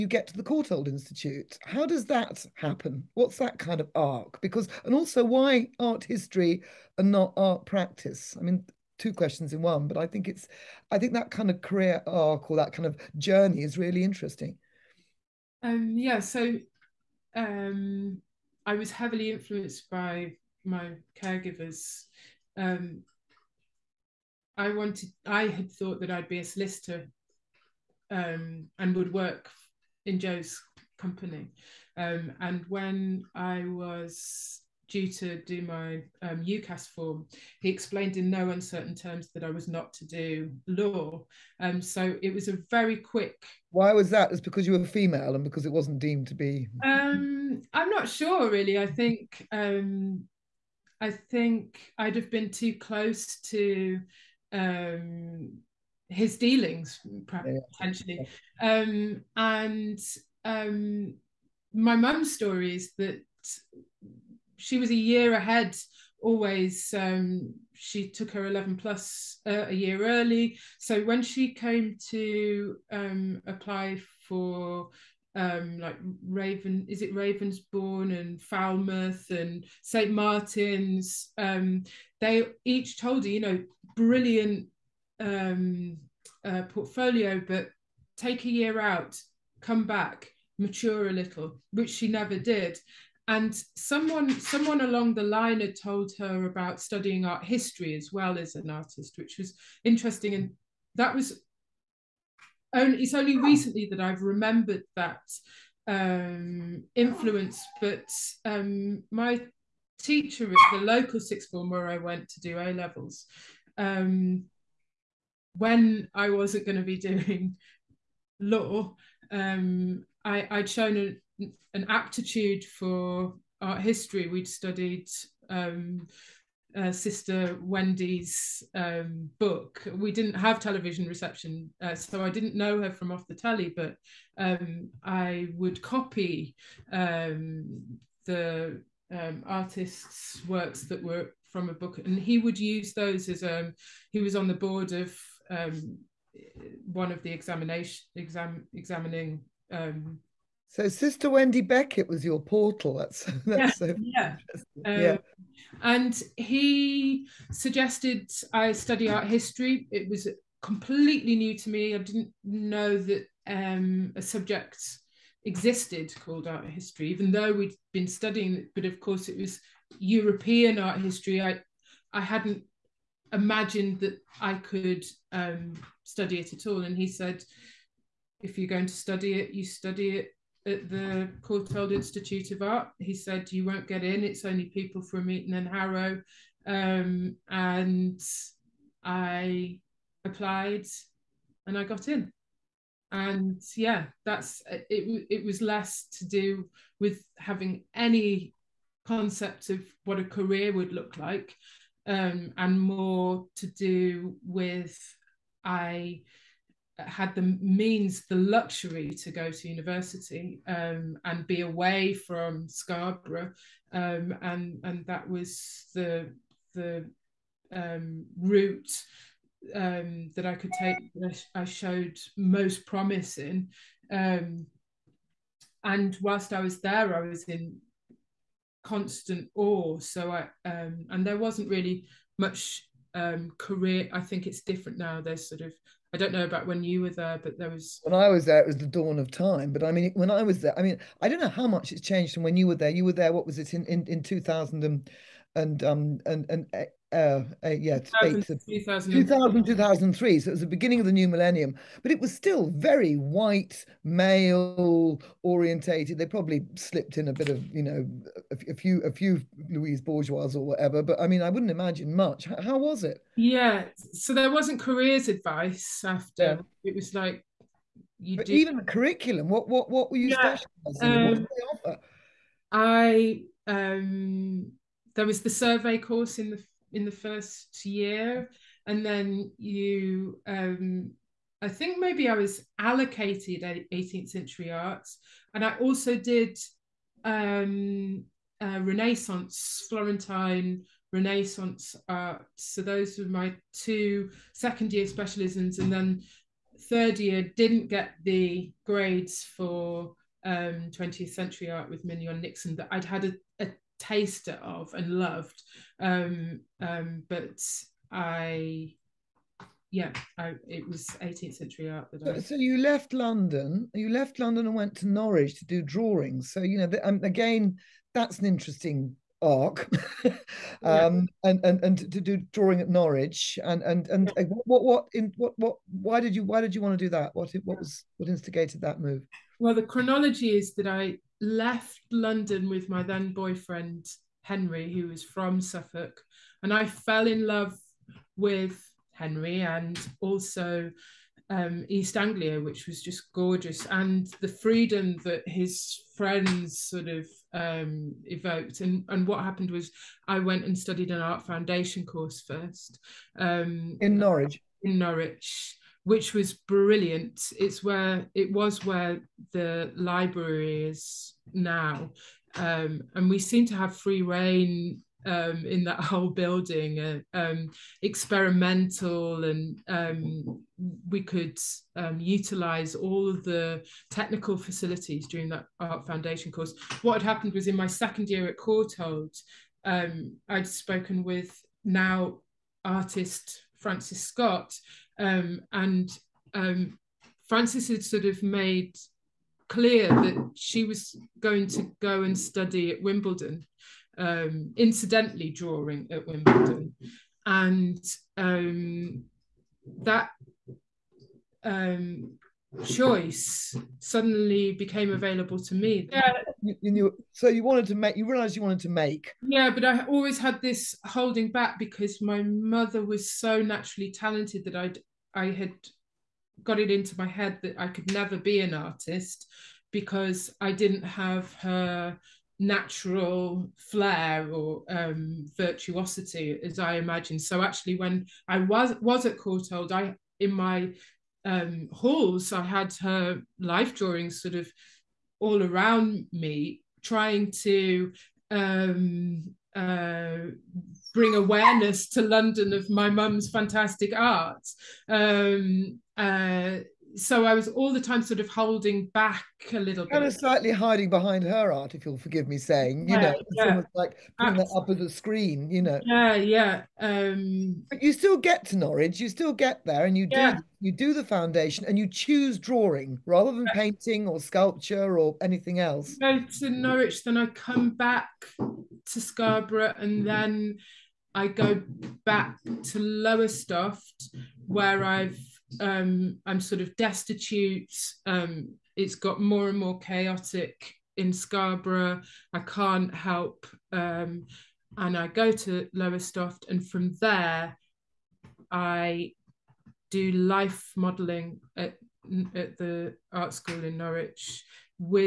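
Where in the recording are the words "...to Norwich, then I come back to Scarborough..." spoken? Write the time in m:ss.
7:46.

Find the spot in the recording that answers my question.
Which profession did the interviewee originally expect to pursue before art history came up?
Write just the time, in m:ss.
0:26.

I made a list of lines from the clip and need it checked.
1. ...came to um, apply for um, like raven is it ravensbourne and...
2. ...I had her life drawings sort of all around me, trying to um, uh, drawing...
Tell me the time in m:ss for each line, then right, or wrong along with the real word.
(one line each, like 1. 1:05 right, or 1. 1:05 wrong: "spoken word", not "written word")
1. 1:11 right
2. 7:12 wrong: "bring", not "drawing".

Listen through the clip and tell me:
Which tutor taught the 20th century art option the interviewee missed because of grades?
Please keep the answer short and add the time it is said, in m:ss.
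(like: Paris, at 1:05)
Mignon Nixon, at 5:02.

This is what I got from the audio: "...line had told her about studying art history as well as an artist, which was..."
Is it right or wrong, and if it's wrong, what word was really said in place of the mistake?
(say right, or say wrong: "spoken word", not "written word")
right.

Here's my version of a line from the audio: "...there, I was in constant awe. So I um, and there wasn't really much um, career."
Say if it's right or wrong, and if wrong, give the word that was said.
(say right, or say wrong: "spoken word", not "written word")
right.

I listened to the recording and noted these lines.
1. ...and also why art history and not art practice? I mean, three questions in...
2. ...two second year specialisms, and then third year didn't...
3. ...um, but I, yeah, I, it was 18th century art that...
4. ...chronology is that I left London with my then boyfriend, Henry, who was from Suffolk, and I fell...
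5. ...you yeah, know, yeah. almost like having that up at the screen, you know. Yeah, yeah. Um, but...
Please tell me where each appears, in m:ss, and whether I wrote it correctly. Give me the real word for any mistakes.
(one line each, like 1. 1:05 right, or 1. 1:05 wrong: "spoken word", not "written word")
1. 0:04 wrong: "two", not "three"
2. 4:53 right
3. 5:06 right
4. 5:29 right
5. 7:33 wrong: "putting", not "having".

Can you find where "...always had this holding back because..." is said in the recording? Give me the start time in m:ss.
6:50.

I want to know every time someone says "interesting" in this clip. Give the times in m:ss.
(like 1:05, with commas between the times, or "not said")
0:14, 1:39, 5:18.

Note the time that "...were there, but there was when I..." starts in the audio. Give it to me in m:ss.
3:57.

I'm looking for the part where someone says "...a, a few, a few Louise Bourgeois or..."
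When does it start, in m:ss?
4:18.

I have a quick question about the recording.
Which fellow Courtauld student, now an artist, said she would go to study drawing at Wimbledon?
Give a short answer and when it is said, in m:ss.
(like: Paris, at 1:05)
Frances Scott, at 6:23.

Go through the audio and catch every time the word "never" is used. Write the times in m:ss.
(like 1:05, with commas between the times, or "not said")
1:32, 6:58.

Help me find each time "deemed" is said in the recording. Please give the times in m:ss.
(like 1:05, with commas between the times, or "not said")
0:45.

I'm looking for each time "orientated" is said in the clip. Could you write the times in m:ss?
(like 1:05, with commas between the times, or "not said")
4:15.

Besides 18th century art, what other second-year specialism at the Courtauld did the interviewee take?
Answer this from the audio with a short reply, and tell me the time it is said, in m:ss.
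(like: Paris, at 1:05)
Florentine Renaissance art, at 4:49.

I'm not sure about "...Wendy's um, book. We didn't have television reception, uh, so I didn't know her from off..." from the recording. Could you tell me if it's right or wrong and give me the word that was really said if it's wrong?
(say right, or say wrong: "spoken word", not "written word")
right.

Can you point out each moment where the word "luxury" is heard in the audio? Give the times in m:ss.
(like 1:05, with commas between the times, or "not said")
3:28.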